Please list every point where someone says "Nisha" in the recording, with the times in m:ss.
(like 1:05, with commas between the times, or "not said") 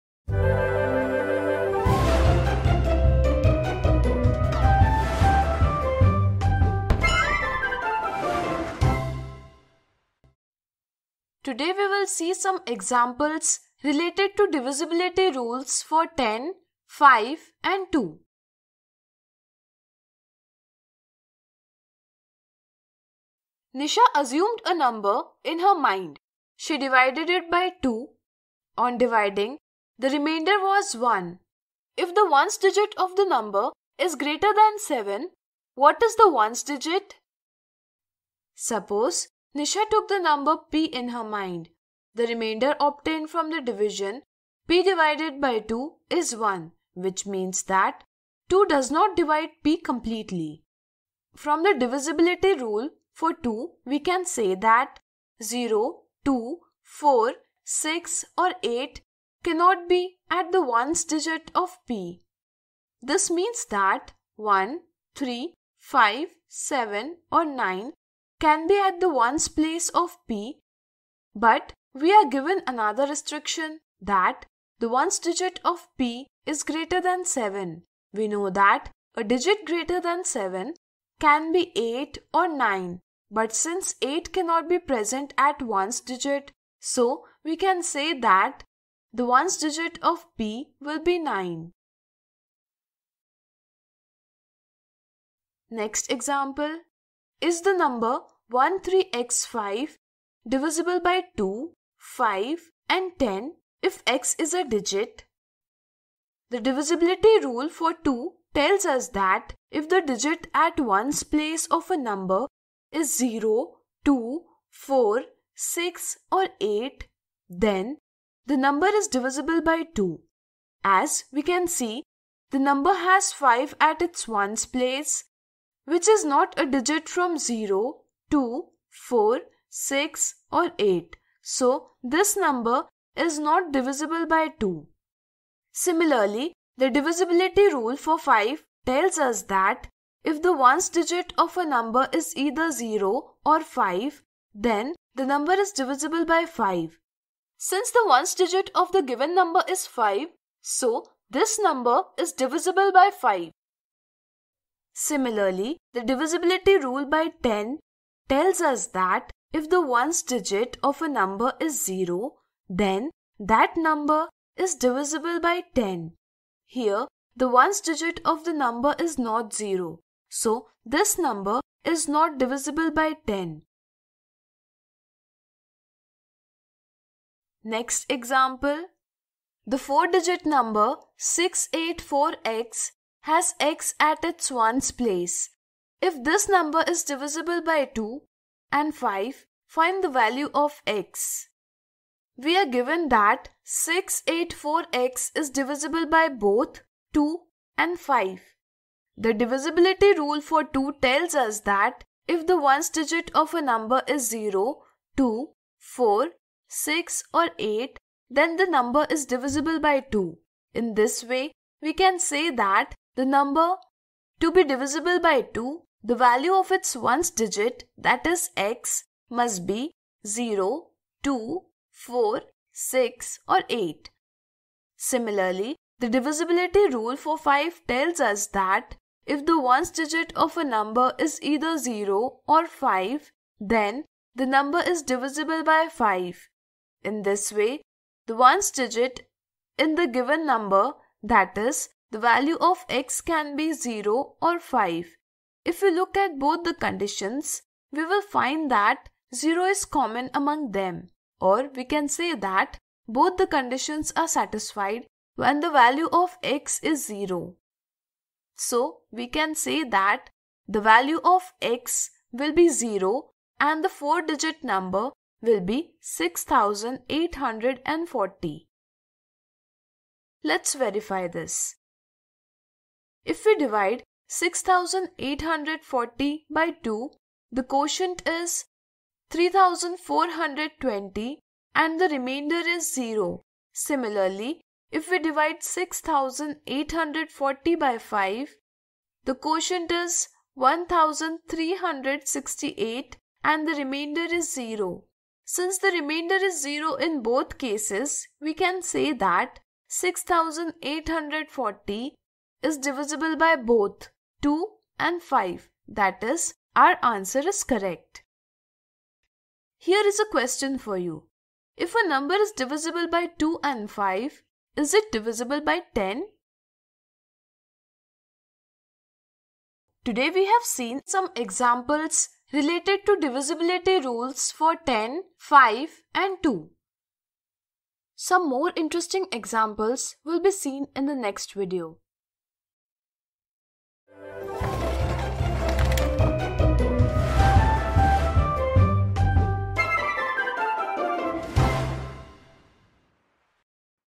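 0:23, 0:39.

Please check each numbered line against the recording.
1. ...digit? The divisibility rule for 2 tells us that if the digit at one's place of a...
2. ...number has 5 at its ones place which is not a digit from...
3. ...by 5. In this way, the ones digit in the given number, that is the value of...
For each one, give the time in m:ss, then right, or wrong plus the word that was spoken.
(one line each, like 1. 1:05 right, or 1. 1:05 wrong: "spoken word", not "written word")
1. 1:44 right
2. 2:02 right
3. 3:55 right.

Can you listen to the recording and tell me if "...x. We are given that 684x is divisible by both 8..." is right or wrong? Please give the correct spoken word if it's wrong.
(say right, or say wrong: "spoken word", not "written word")
wrong: "2", not "8".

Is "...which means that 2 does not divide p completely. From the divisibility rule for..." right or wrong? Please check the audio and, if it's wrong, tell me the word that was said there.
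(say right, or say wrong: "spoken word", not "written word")
right.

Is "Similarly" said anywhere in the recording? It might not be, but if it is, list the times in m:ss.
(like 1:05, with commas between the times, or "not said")
2:15, 2:34, 3:44.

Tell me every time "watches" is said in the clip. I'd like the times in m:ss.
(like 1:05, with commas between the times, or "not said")
not said.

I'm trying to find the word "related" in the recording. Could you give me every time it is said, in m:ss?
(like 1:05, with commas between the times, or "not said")
0:13, 5:22.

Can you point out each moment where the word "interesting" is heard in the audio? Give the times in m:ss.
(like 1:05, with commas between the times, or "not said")
5:28.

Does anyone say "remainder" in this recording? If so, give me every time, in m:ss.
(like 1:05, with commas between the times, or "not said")
0:30, 0:42.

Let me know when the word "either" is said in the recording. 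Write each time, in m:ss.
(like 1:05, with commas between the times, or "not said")
2:22, 3:51.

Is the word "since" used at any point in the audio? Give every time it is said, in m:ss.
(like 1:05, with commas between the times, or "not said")
1:23, 2:27.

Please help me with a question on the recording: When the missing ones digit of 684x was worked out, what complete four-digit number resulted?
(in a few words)
6840.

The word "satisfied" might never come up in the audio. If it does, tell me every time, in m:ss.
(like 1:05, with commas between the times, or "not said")
4:14.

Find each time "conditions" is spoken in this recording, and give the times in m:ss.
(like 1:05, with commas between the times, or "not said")
4:06, 4:13.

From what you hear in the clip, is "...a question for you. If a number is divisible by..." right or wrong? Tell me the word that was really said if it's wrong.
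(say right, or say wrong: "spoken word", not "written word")
right.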